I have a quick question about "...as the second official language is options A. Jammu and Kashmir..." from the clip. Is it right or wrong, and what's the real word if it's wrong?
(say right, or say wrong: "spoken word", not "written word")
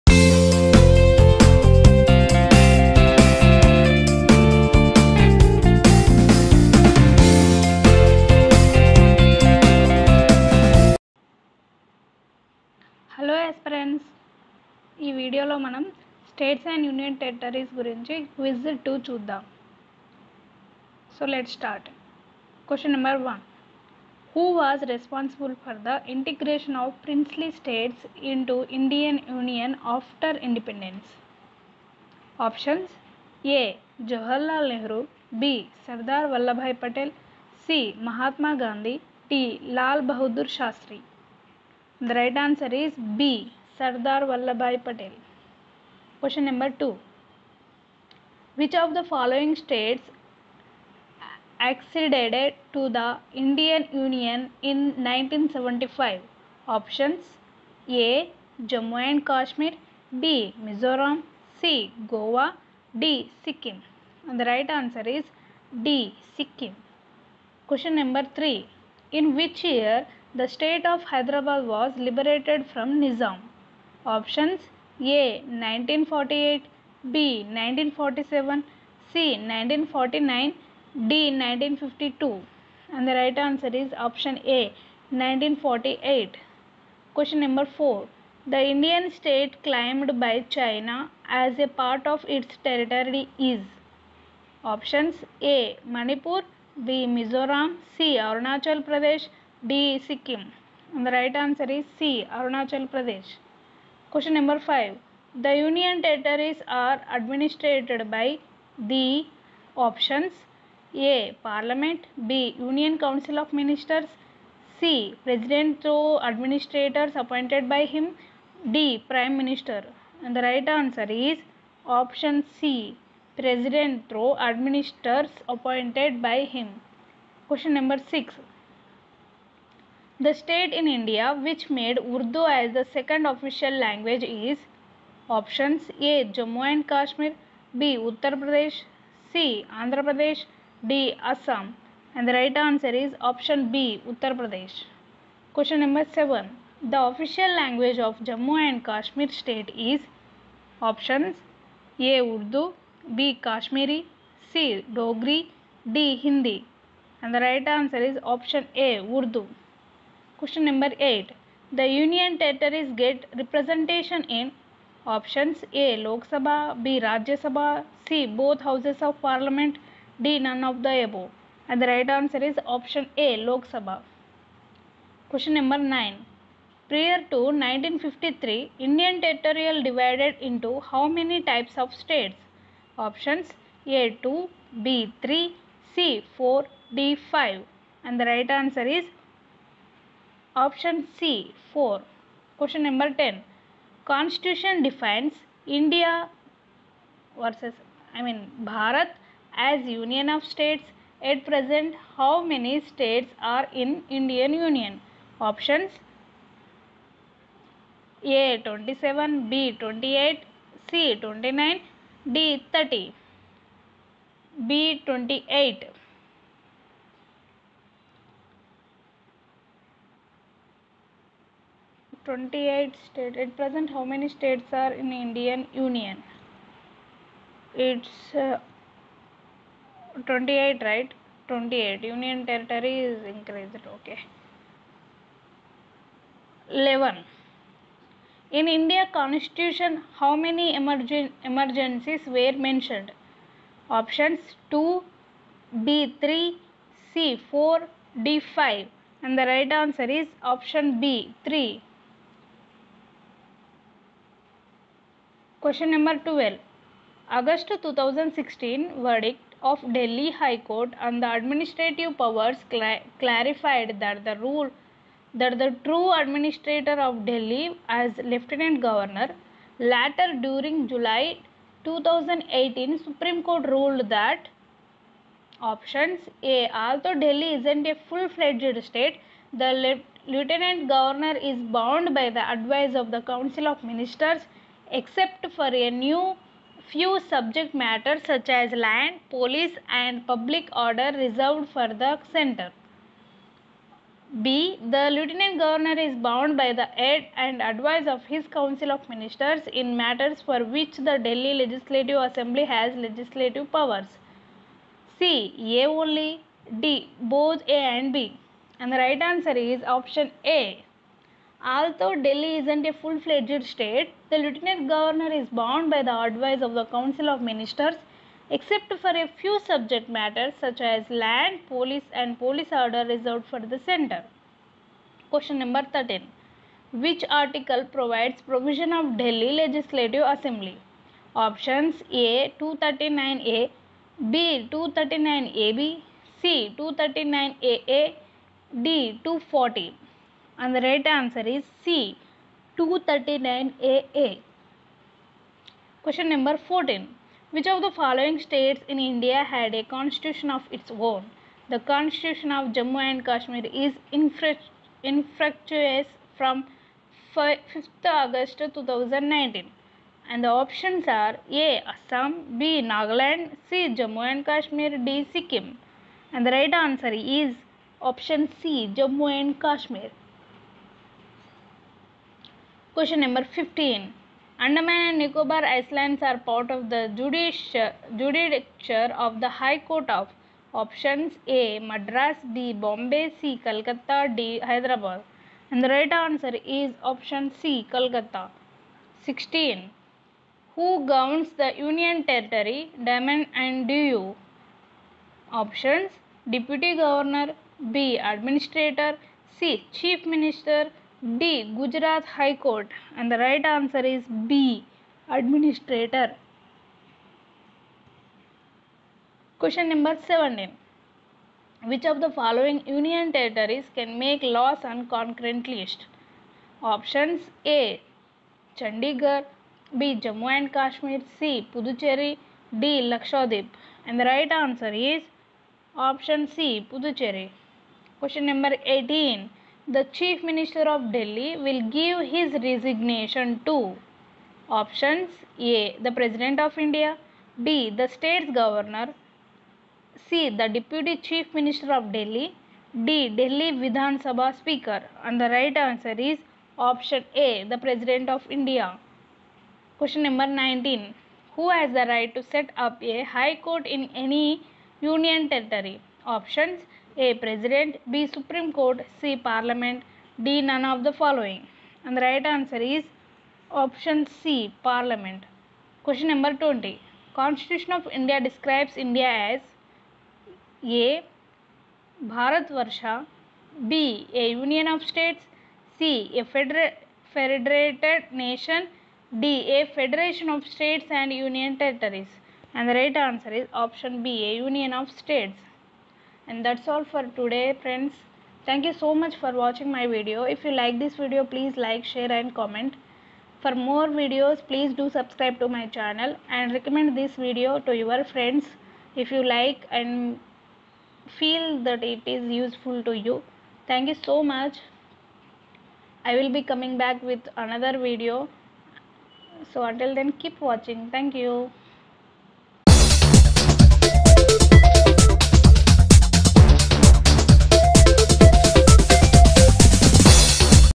right.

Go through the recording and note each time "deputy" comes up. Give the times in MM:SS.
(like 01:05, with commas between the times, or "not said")
06:36, 07:20.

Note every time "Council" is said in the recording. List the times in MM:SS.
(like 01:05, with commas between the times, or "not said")
01:52, 04:43, 04:58, 05:16.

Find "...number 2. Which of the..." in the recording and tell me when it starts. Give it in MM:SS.
00:46.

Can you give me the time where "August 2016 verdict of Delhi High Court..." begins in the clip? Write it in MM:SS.
04:17.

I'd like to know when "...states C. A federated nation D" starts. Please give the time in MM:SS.
07:55.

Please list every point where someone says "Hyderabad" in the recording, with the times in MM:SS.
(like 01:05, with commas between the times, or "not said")
01:11, 06:24.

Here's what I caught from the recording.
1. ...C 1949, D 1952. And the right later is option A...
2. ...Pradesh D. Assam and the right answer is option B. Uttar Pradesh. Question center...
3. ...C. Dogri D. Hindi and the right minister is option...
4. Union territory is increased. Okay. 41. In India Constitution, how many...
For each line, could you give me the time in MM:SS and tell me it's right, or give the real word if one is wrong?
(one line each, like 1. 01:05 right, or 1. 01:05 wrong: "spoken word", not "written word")
1. 01:19 wrong: "answer", not "later"
2. 02:20 wrong: "number", not "center"
3. 02:34 wrong: "answer", not "minister"
4. 03:52 wrong: "11", not "41".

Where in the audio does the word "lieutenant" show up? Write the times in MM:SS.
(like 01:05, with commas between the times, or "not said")
04:28, 04:40, 04:55, 05:14.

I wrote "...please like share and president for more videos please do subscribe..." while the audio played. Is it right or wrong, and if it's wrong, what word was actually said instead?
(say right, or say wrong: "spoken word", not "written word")
wrong: "comment", not "president".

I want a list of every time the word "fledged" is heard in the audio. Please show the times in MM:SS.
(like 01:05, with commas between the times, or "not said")
04:38, 05:12.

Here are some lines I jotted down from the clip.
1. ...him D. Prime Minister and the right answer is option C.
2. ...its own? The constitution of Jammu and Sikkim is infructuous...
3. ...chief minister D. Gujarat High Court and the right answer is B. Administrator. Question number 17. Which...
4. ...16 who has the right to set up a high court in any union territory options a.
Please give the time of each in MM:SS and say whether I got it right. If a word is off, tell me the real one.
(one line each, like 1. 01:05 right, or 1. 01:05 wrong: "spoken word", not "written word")
1. 01:57 right
2. 05:50 wrong: "Kashmir", not "Sikkim"
3. 06:39 right
4. 07:30 wrong: "19", not "16".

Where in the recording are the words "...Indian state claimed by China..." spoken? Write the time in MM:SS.
01:28.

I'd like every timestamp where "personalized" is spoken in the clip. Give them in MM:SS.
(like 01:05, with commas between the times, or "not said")
not said.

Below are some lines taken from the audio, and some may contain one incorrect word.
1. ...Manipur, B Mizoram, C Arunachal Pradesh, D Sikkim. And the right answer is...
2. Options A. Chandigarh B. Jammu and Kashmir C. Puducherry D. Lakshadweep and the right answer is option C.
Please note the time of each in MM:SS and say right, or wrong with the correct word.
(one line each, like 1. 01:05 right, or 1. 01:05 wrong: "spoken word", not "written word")
1. 01:35 right
2. 06:56 right.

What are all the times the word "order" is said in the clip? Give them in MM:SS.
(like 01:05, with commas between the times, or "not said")
04:50, 05:22.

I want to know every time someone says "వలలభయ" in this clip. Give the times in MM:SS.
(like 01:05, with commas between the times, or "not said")
00:36.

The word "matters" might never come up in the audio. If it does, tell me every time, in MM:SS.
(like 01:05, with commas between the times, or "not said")
04:47, 04:59, 05:20.